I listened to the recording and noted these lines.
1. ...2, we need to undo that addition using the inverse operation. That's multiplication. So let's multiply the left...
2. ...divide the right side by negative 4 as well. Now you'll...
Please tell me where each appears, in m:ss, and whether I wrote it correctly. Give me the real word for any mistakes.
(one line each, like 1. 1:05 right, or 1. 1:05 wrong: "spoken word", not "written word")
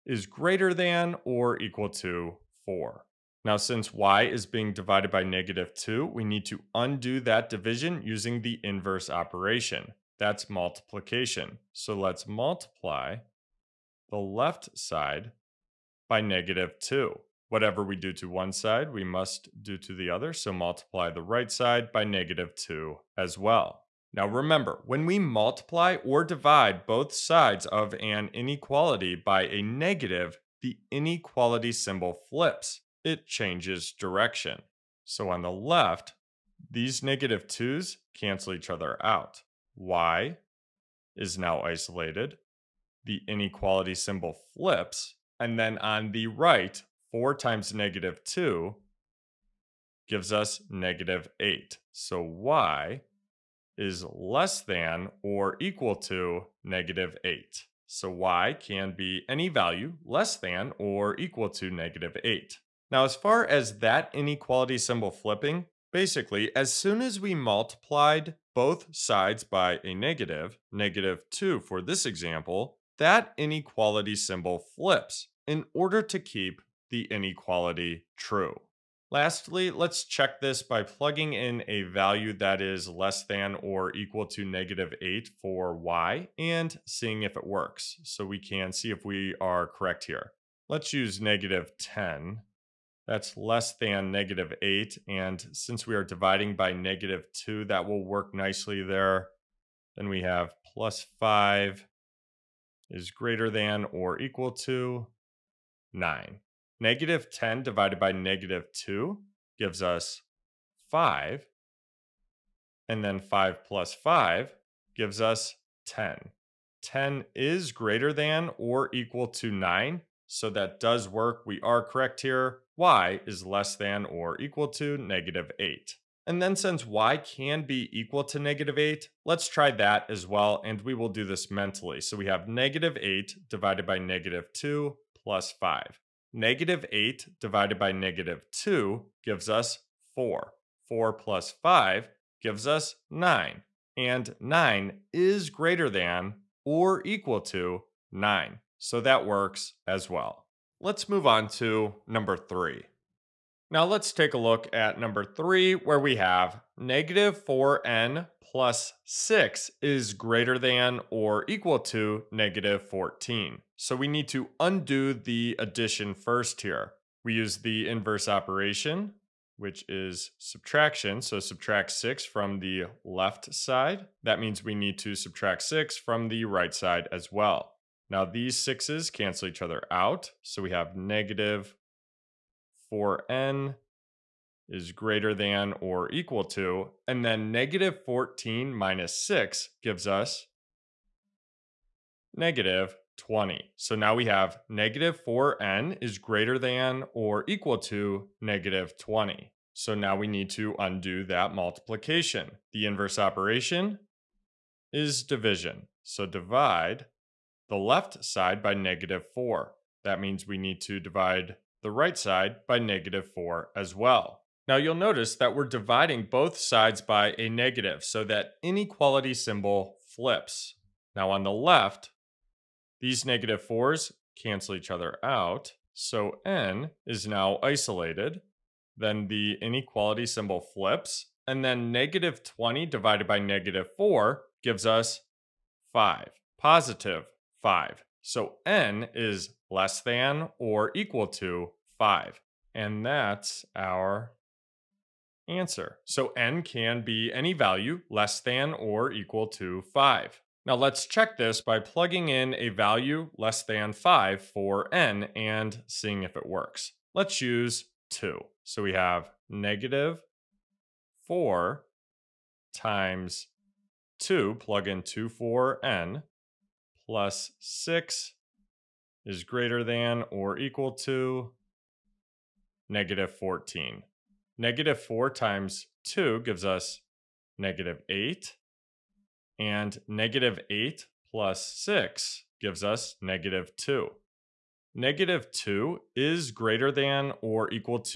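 1. 0:05 wrong: "division", not "addition"
2. 3:30 right.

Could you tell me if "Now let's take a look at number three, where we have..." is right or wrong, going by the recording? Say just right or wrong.
right.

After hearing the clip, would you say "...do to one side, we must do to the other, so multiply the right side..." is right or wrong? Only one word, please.
right.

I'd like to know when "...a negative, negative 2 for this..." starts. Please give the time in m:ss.
1:09.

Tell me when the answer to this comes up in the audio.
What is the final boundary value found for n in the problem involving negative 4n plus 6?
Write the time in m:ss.
4:01.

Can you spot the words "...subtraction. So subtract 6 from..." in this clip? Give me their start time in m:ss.
2:50.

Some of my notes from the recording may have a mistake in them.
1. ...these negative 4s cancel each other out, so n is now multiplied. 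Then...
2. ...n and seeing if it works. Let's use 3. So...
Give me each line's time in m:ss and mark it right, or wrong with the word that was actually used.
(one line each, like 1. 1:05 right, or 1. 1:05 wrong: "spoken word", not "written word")
1. 3:42 wrong: "isolated", not "multiplied"
2. 4:14 wrong: "2", not "3".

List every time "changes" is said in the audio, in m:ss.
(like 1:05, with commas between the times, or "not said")
0:33.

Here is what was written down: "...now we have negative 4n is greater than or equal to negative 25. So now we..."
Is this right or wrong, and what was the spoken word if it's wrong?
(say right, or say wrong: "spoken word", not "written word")
wrong: "20", not "25".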